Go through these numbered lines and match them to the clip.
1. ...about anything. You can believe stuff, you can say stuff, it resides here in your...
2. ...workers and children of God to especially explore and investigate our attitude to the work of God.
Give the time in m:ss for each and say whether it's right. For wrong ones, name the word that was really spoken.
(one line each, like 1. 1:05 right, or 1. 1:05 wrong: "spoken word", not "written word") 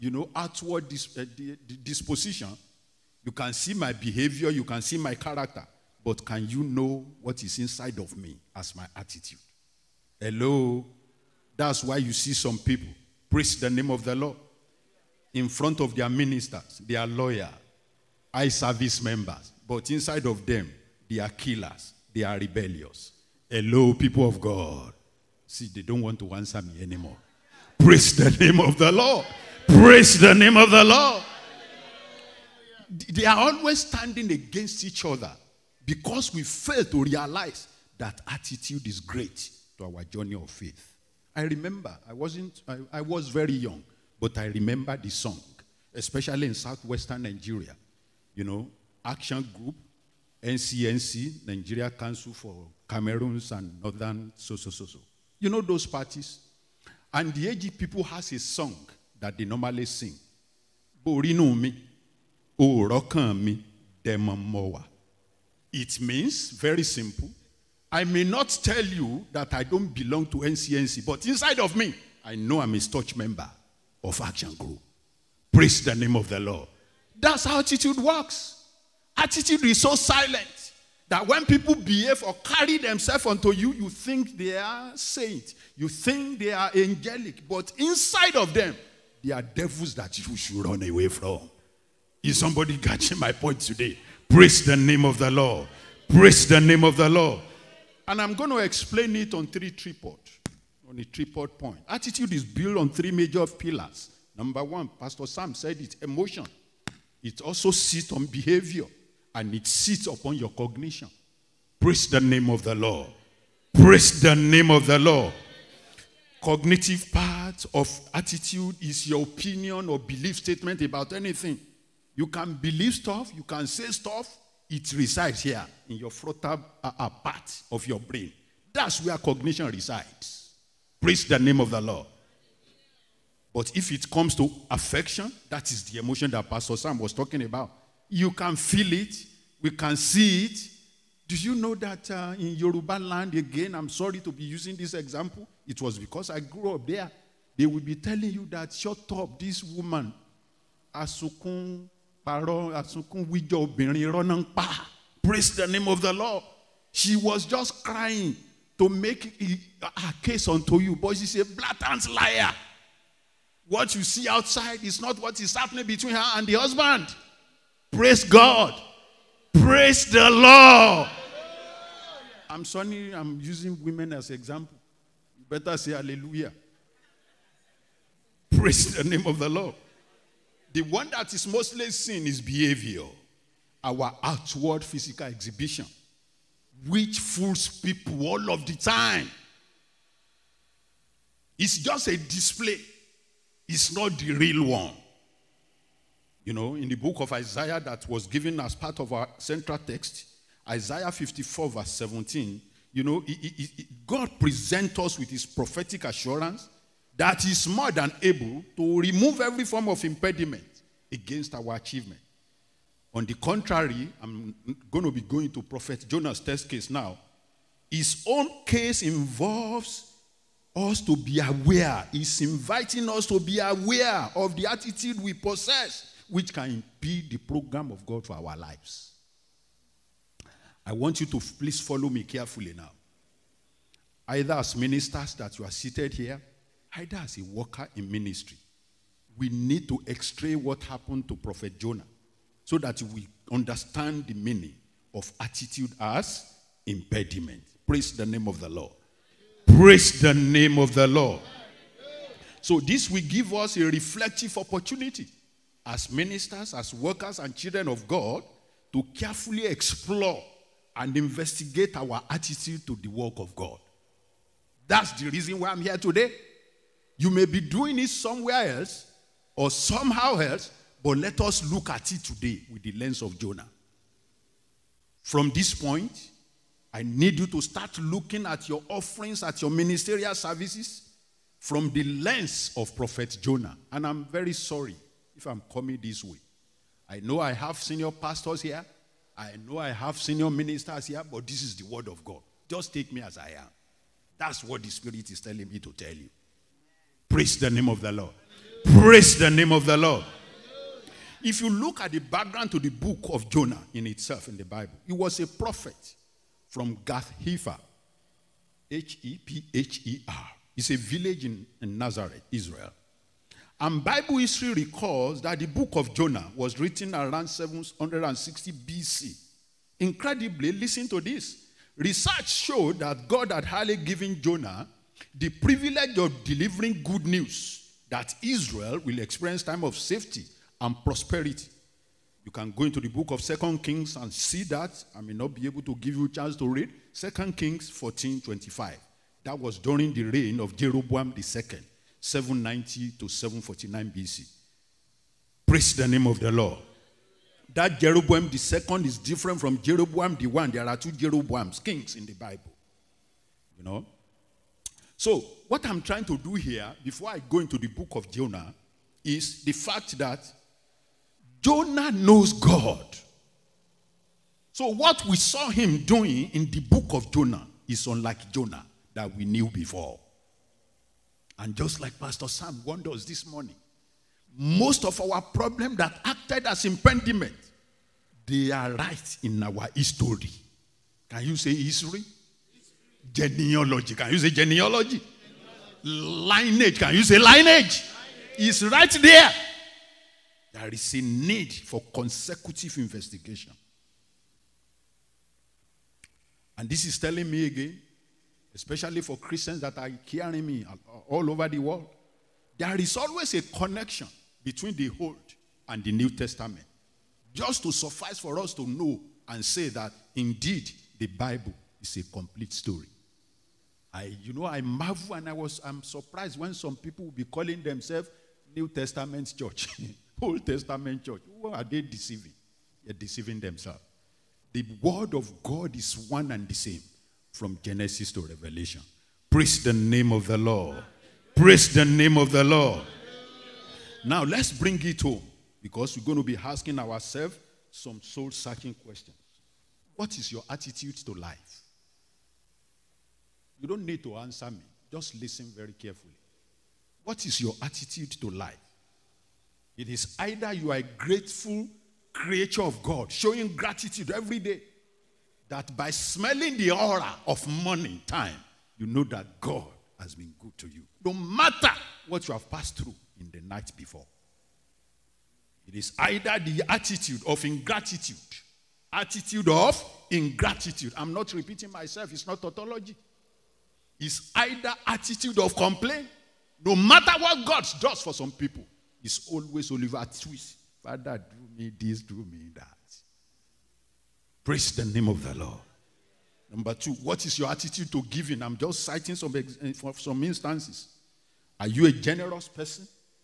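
1. 2:00 right
2. 4:16 wrong: "carefully", not "especially".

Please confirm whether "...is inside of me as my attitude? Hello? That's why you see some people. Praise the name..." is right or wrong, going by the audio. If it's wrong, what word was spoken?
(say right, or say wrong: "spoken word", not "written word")
right.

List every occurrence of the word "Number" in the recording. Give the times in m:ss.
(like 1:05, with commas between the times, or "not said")
1:44, 8:06.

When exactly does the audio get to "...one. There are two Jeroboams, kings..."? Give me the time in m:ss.
5:50.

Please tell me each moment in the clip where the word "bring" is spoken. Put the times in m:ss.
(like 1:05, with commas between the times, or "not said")
7:14.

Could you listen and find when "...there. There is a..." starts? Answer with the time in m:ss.
6:29.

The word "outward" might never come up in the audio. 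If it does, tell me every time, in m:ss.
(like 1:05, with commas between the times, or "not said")
0:00, 3:04.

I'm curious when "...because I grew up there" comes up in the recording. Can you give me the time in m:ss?
2:25.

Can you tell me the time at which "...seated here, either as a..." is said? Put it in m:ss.
3:55.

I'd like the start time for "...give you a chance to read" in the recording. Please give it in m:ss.
5:35.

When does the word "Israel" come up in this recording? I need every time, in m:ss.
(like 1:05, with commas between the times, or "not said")
5:12, 5:28.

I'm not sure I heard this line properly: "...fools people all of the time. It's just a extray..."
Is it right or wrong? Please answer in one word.
wrong.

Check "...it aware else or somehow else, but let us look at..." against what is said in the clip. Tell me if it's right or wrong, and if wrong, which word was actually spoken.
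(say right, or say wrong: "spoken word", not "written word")
wrong: "somewhere", not "aware".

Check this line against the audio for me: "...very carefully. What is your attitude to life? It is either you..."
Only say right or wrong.
right.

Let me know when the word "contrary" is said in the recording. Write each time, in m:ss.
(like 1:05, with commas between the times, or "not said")
3:33.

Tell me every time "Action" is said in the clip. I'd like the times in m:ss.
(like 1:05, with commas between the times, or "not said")
0:49, 1:14.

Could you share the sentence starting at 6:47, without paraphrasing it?
Just to suffice for us to know and say that indeed the Bible is a complete story.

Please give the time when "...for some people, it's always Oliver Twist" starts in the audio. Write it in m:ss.
7:58.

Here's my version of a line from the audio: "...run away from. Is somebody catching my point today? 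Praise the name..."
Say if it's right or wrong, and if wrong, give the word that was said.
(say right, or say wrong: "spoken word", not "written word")
right.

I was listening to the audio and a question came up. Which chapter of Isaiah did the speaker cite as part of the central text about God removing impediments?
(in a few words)
54.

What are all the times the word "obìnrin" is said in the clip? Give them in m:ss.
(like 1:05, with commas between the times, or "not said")
2:33.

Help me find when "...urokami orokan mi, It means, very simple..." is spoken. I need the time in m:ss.
1:02.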